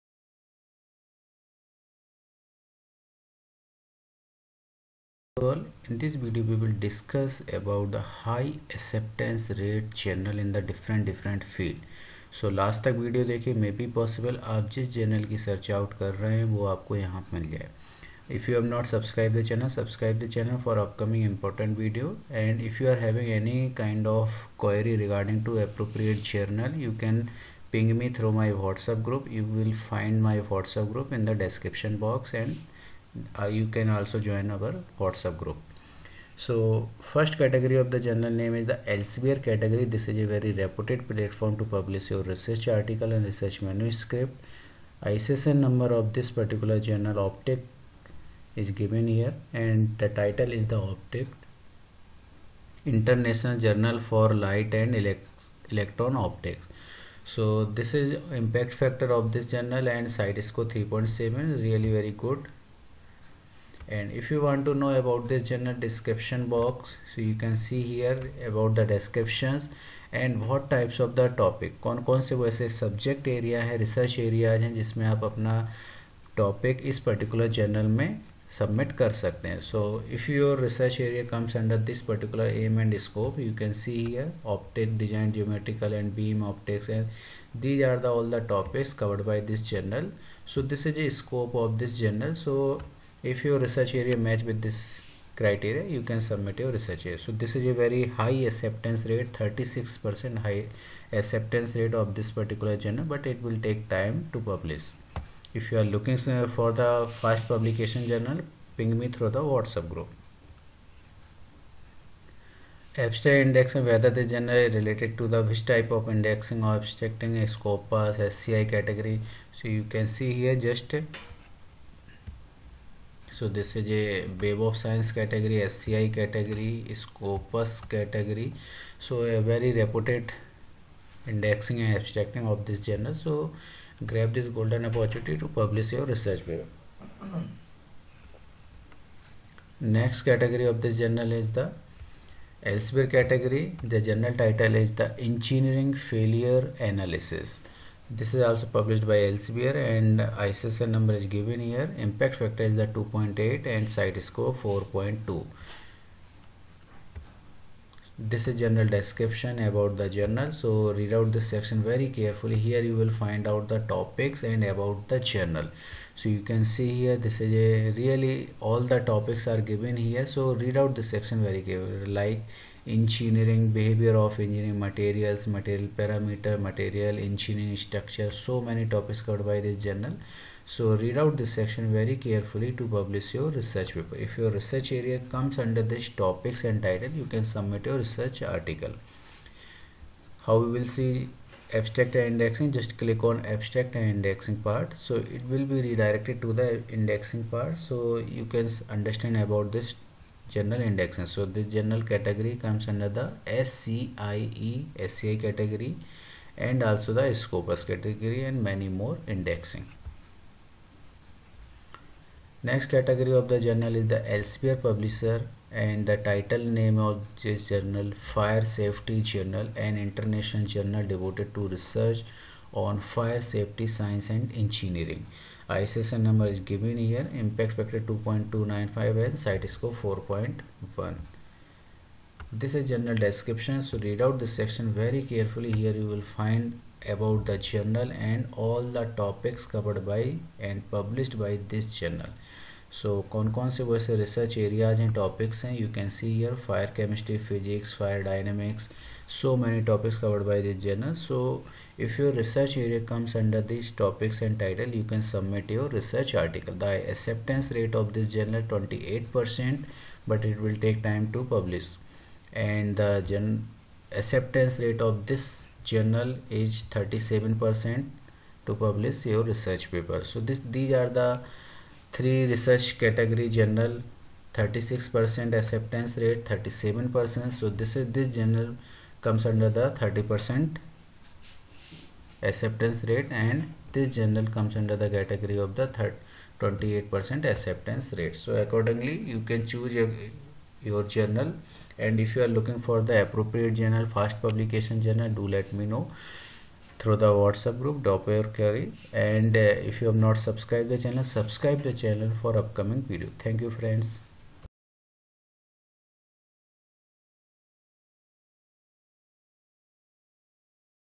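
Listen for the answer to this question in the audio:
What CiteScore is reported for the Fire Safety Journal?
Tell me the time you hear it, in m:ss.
3:50.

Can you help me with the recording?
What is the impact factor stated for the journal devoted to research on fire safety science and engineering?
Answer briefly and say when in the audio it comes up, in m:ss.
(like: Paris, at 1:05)
2.295, at 3:48.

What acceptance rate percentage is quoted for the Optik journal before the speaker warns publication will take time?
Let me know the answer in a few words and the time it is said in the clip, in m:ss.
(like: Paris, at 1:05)
36 percent, at 1:39.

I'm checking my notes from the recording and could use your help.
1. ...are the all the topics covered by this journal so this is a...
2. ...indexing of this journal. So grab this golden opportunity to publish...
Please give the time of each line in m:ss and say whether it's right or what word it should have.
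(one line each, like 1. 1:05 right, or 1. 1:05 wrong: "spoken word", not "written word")
1. 1:27 right
2. 2:11 wrong: "abstracting", not "indexing".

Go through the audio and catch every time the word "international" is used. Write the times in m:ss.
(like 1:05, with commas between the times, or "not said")
0:52, 3:40.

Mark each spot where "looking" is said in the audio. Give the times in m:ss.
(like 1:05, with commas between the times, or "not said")
1:45, 4:52.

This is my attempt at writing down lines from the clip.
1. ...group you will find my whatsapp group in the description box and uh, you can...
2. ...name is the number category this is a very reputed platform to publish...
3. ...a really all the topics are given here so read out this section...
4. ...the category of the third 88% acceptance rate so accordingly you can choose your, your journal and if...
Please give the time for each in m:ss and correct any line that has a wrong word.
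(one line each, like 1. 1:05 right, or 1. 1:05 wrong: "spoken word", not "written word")
1. 0:29 right
2. 0:38 wrong: "elsevier", not "number"
3. 2:47 right
4. 4:44 wrong: "28", not "88".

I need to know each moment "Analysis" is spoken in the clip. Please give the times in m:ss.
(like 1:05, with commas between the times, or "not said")
2:26.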